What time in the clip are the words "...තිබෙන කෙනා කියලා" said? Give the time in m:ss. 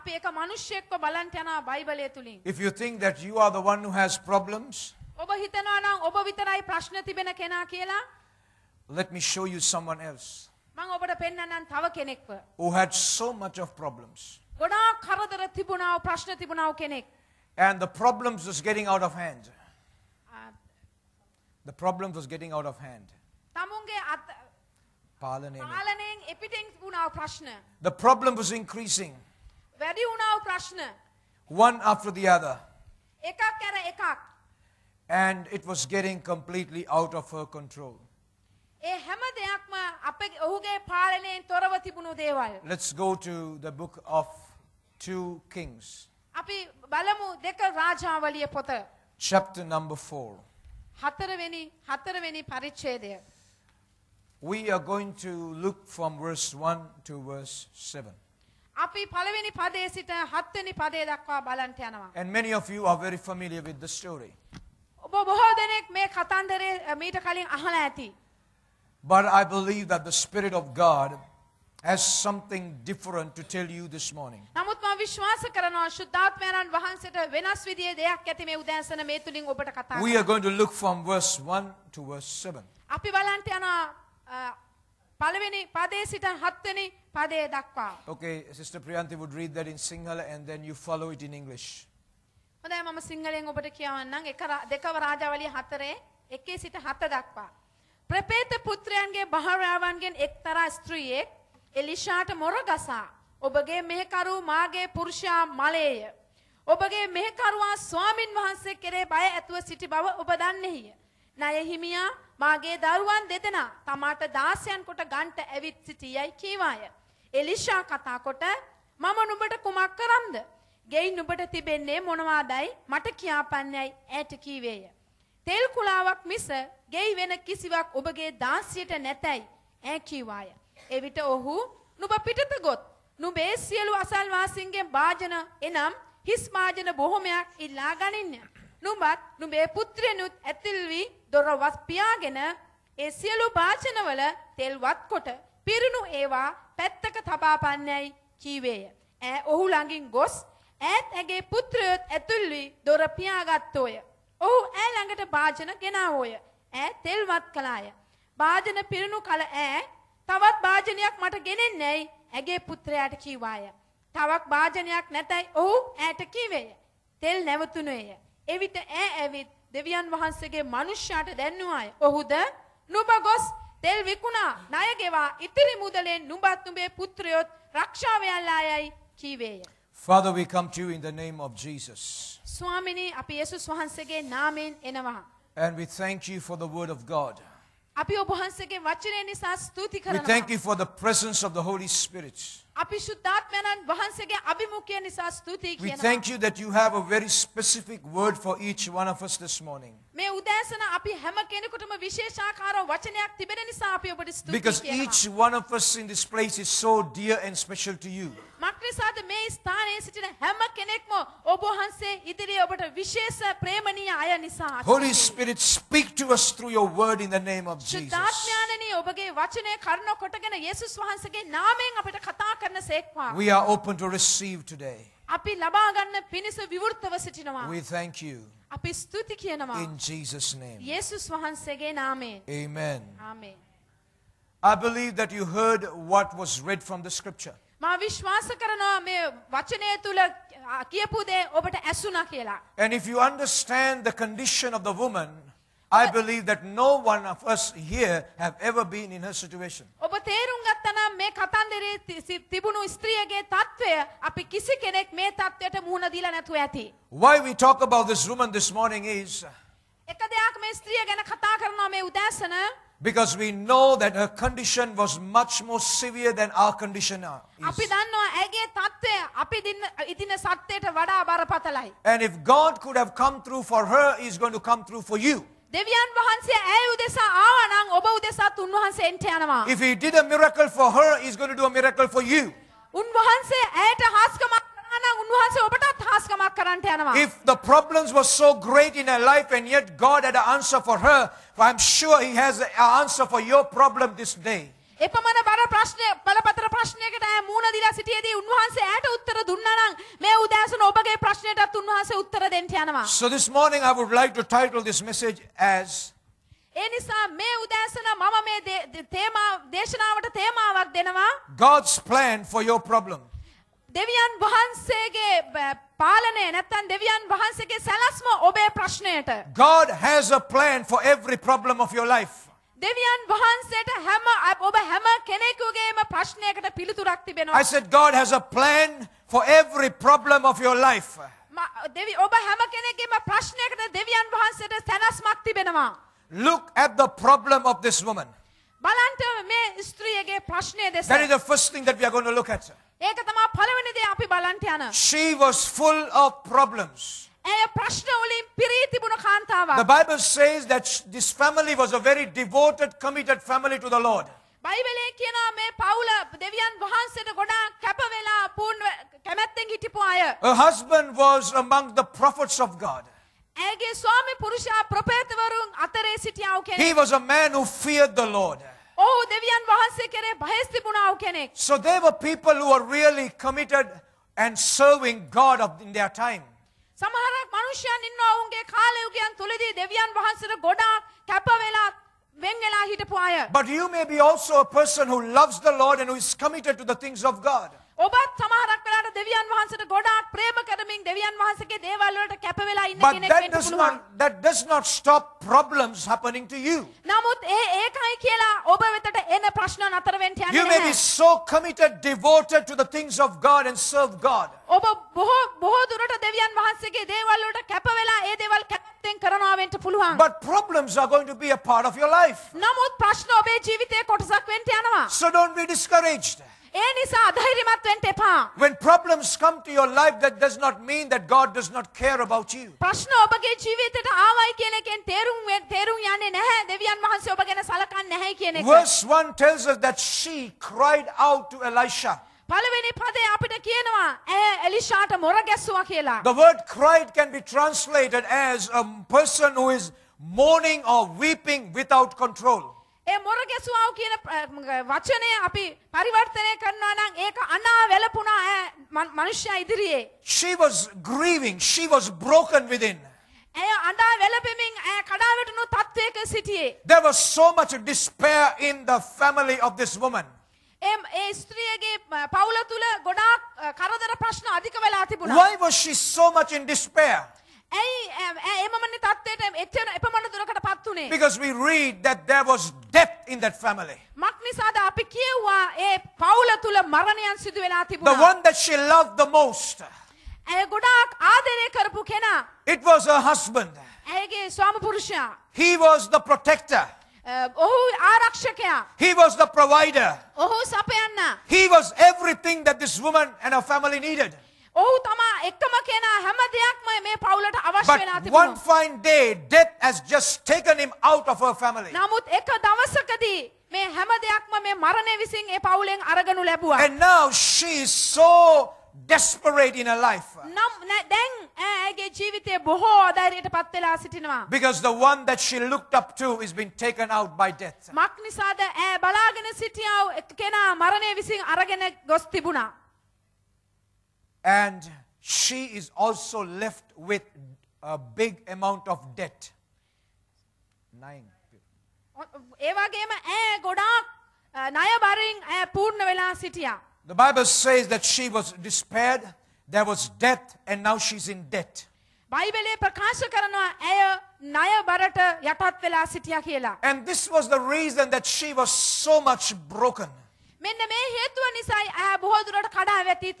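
0:07.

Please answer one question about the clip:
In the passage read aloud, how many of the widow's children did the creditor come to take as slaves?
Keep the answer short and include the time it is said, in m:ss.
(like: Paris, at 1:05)
2, at 1:53.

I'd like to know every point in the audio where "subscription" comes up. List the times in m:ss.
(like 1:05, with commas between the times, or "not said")
not said.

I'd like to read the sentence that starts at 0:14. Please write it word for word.
ගොඩාක් කරදර තිබුණා ප්‍රශ්න තිබුණා කෙනෙක්.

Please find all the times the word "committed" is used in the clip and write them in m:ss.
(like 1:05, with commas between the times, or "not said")
5:52, 6:13, 6:26, 6:41.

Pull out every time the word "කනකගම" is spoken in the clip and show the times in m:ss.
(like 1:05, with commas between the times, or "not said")
5:25, 5:32.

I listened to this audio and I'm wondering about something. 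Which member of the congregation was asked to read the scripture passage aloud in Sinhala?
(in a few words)
Sister Priyanti.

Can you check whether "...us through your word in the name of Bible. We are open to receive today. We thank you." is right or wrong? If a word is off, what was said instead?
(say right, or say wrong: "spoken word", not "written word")
wrong: "Jesus", not "Bible".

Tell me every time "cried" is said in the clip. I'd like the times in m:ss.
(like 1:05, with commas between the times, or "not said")
7:10, 7:16.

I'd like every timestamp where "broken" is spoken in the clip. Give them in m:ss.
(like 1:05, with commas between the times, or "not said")
7:32, 9:09.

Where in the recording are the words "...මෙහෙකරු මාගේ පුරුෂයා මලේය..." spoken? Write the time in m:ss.
1:43.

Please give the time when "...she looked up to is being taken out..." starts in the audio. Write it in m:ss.
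8:35.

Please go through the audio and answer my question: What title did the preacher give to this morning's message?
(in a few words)
God's plan for your problem.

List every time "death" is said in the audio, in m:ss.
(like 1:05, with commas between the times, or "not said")
8:19, 8:37, 9:00.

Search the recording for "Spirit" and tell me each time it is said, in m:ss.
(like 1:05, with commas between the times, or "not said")
1:10, 3:35.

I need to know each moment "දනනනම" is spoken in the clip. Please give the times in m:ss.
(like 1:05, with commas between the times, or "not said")
4:59.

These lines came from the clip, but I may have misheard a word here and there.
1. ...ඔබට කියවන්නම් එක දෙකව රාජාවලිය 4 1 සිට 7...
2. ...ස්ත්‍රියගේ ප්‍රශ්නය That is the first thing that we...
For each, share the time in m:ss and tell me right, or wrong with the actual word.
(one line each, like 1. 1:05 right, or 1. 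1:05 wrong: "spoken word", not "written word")
1. 1:33 right
2. 5:39 right.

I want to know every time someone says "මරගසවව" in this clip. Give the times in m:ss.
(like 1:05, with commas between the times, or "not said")
7:23.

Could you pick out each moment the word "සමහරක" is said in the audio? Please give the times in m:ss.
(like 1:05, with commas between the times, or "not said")
6:17, 6:28.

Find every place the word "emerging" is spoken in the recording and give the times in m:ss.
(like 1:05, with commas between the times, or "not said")
not said.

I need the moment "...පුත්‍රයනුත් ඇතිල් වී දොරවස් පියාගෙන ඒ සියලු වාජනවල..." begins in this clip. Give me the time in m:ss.
2:19.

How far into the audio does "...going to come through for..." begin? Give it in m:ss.
4:34.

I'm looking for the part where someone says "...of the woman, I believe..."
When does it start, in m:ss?
4:04.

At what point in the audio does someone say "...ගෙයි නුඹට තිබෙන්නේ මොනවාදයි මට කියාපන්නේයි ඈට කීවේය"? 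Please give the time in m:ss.
2:00.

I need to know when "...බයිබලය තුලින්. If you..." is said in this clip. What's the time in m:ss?
0:01.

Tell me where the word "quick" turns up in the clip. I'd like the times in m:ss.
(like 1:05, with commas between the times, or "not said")
not said.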